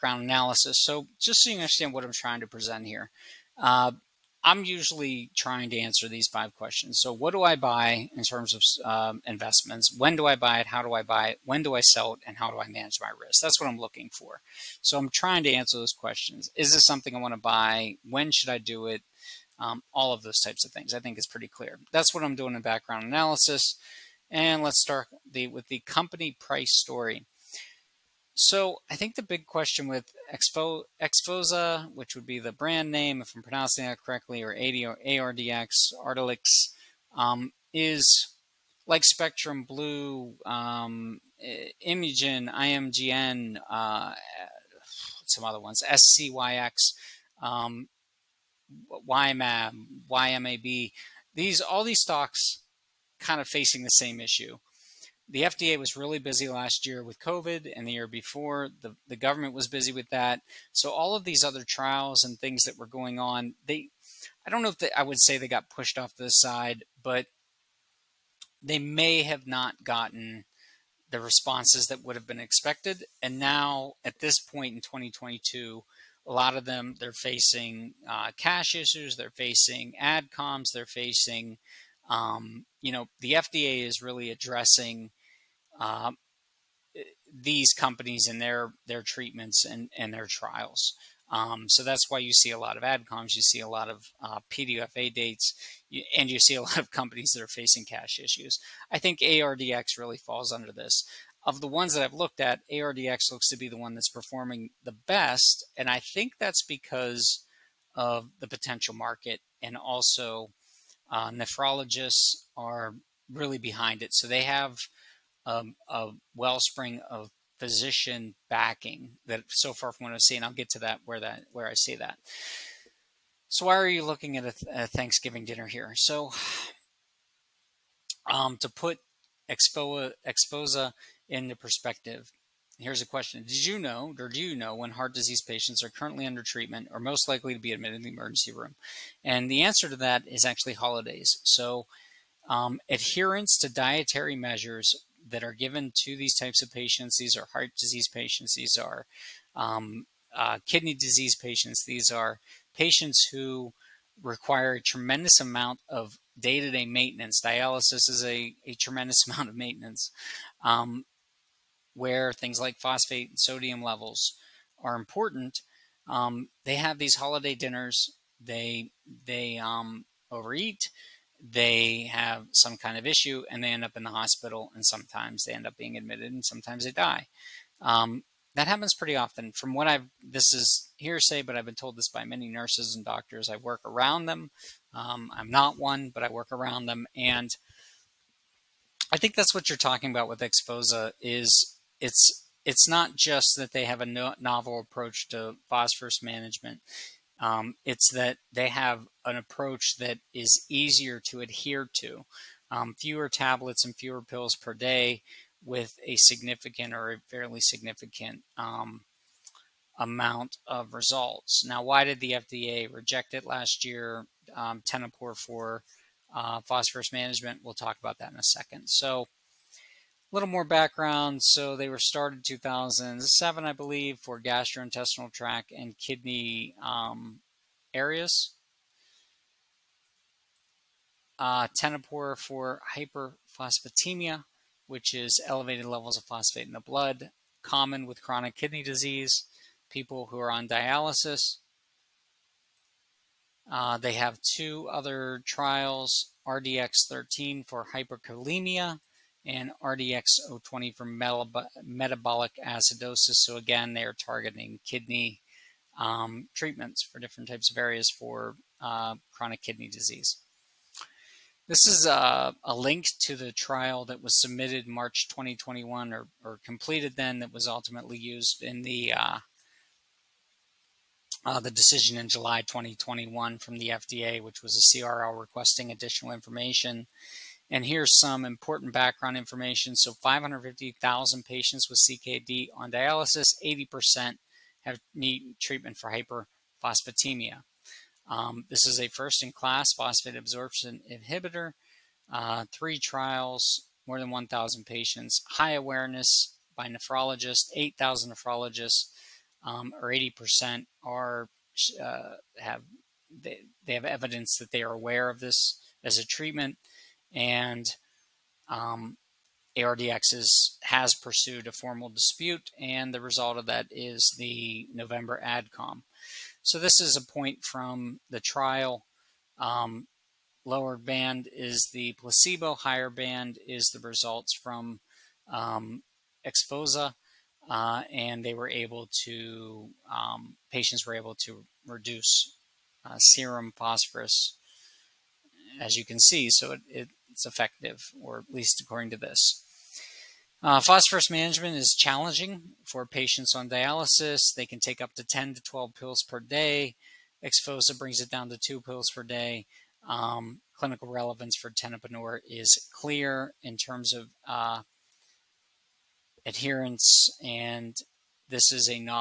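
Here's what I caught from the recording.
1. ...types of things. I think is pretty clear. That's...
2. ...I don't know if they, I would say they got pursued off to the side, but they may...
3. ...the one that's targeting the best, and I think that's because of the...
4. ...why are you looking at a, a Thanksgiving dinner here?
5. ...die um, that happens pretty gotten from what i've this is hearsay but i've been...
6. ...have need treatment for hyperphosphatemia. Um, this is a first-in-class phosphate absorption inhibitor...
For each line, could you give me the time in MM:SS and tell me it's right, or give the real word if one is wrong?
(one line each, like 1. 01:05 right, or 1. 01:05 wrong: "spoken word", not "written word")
1. 00:20 right
2. 01:04 wrong: "pushed", not "pursued"
3. 01:43 wrong: "performing", not "targeting"
4. 02:03 right
5. 02:56 wrong: "often", not "gotten"
6. 04:44 right.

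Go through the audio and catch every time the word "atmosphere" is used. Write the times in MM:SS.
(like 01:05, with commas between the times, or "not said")
not said.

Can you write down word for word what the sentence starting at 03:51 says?
Uh, for hyperphosphatemia, which is elevated levels of phosphate in the blood, common with chronic kidney disease, people who are on dialysis.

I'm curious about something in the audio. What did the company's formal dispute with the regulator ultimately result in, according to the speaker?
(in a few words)
The November ADCOM.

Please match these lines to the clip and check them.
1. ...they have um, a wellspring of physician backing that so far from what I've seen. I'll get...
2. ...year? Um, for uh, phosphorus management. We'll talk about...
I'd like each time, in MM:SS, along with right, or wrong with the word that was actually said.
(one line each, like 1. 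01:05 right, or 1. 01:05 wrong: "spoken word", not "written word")
1. 01:54 right
2. 03:33 right.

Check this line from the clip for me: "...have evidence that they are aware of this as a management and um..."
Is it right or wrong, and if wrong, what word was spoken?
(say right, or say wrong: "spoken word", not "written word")
wrong: "treatment", not "management".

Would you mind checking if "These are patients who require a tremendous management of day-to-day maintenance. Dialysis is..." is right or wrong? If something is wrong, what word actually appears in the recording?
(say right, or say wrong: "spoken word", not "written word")
wrong: "amount", not "management".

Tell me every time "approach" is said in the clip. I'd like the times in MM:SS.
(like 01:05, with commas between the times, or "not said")
03:14, 03:19.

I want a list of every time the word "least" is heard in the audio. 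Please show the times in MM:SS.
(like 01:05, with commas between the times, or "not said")
05:38.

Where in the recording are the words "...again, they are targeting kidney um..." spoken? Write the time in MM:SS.
04:13.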